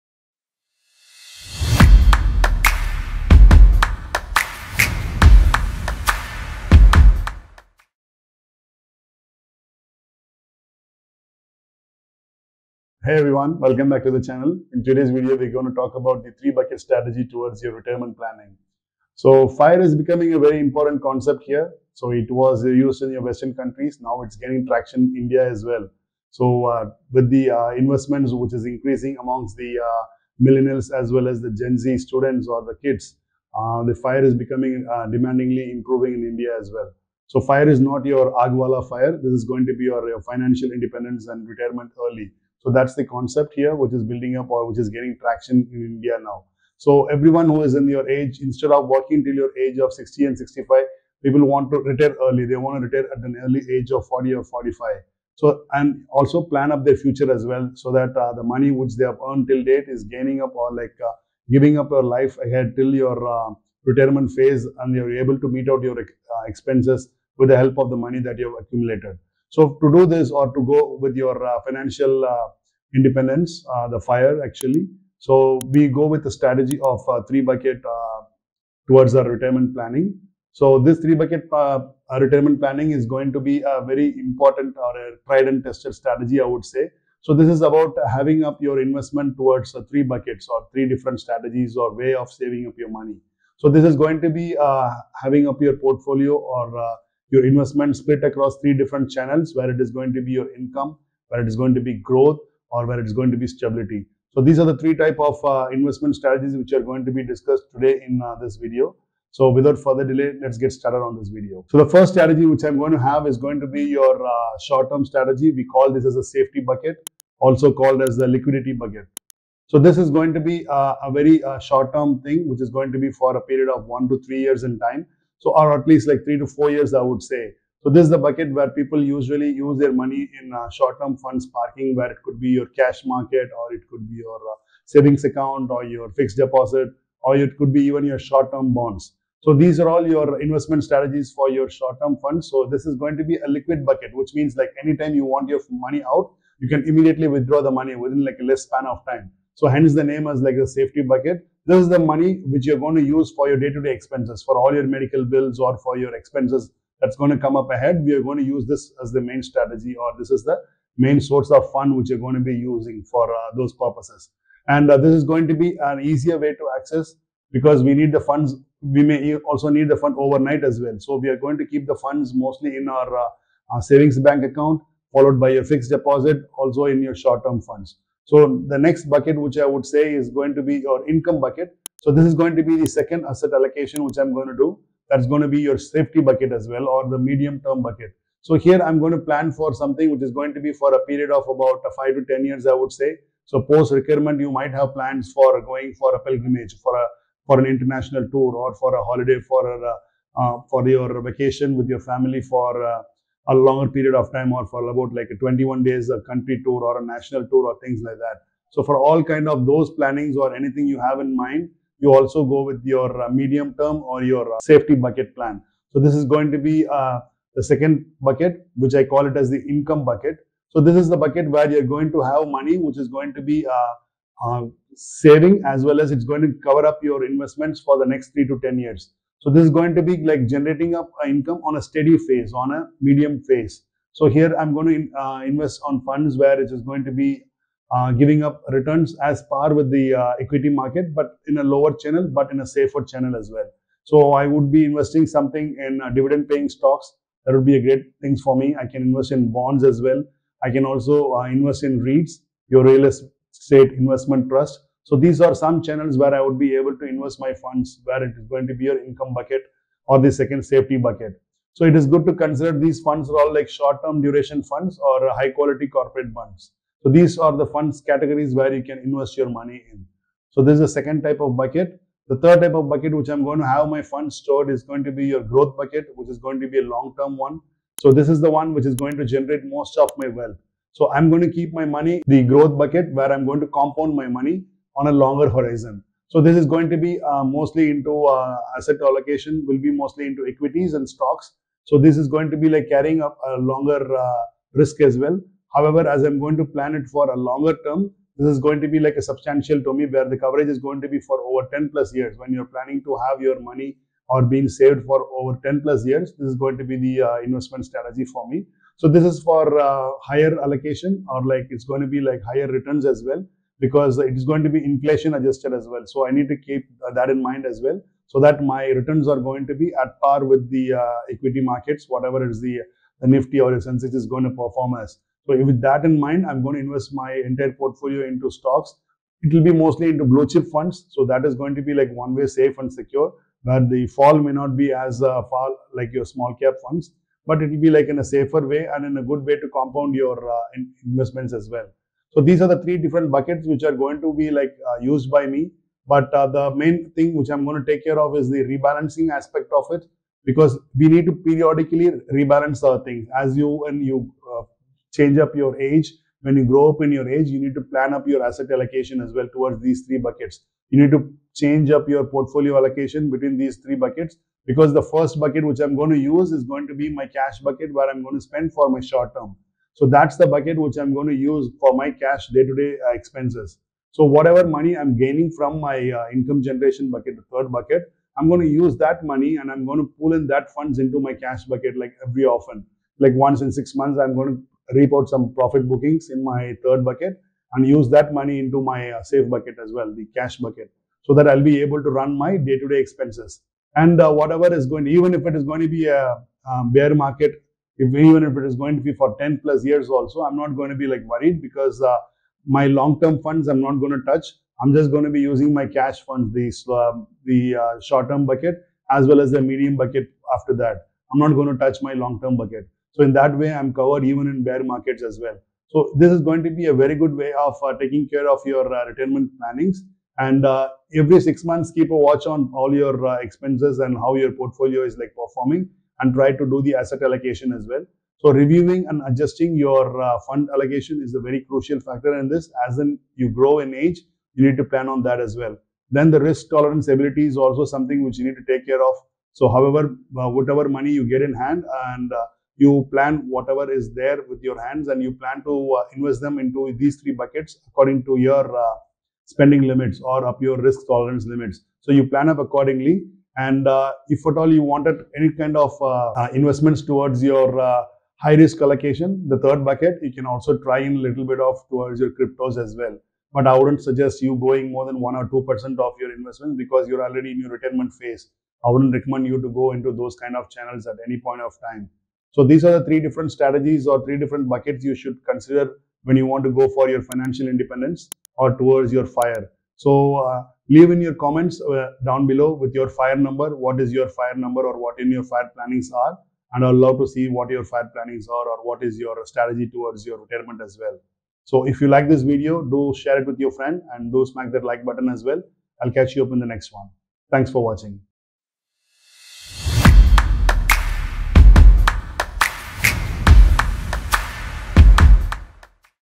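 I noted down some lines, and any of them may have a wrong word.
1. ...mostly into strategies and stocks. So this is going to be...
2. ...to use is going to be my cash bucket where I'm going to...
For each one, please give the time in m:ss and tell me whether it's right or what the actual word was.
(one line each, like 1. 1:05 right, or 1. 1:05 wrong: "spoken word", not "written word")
1. 4:49 wrong: "equities", not "strategies"
2. 6:06 right.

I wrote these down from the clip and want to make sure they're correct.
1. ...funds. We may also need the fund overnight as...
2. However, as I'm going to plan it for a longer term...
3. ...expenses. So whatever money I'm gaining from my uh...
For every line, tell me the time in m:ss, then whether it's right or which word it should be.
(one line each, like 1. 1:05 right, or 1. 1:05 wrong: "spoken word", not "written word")
1. 2:48 right
2. 4:55 right
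3. 6:13 right.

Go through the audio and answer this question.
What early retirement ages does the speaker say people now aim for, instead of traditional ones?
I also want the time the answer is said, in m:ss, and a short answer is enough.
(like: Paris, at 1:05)
40 or 45, at 0:54.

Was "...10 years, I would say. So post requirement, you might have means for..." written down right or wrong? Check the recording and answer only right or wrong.
wrong.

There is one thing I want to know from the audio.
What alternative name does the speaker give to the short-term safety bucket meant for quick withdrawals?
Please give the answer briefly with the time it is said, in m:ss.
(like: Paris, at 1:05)
liquidity bucket, at 1:58.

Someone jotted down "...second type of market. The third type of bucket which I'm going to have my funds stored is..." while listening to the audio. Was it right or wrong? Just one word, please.
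wrong.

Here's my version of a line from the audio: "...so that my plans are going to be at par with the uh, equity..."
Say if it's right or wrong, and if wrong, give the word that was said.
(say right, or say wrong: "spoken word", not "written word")
wrong: "returns", not "plans".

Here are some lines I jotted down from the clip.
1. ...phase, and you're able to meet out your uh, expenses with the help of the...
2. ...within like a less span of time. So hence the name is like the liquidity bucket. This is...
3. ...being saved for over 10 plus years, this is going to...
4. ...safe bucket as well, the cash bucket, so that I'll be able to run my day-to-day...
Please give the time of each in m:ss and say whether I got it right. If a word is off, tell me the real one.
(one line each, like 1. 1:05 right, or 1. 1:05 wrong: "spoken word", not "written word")
1. 1:04 right
2. 2:27 wrong: "safety", not "liquidity"
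3. 5:04 right
4. 6:29 right.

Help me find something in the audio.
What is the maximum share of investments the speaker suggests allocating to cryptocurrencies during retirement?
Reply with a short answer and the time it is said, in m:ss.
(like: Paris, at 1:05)
1 or 2%, at 7:45.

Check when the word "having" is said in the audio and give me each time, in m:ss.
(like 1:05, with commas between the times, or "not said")
1:28, 1:35.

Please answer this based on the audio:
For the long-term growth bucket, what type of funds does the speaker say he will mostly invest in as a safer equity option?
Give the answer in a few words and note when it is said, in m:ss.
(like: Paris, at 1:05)
blue chip funds, at 5:30.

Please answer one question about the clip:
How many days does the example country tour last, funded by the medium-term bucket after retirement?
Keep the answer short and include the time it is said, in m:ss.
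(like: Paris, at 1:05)
21 days, at 3:25.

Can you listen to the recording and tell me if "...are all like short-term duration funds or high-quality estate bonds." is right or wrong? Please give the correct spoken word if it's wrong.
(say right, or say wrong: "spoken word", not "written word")
wrong: "corporate", not "estate".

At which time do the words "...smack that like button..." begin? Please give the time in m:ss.
8:14.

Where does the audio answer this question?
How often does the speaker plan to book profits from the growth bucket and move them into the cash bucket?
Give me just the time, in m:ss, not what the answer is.
6:23.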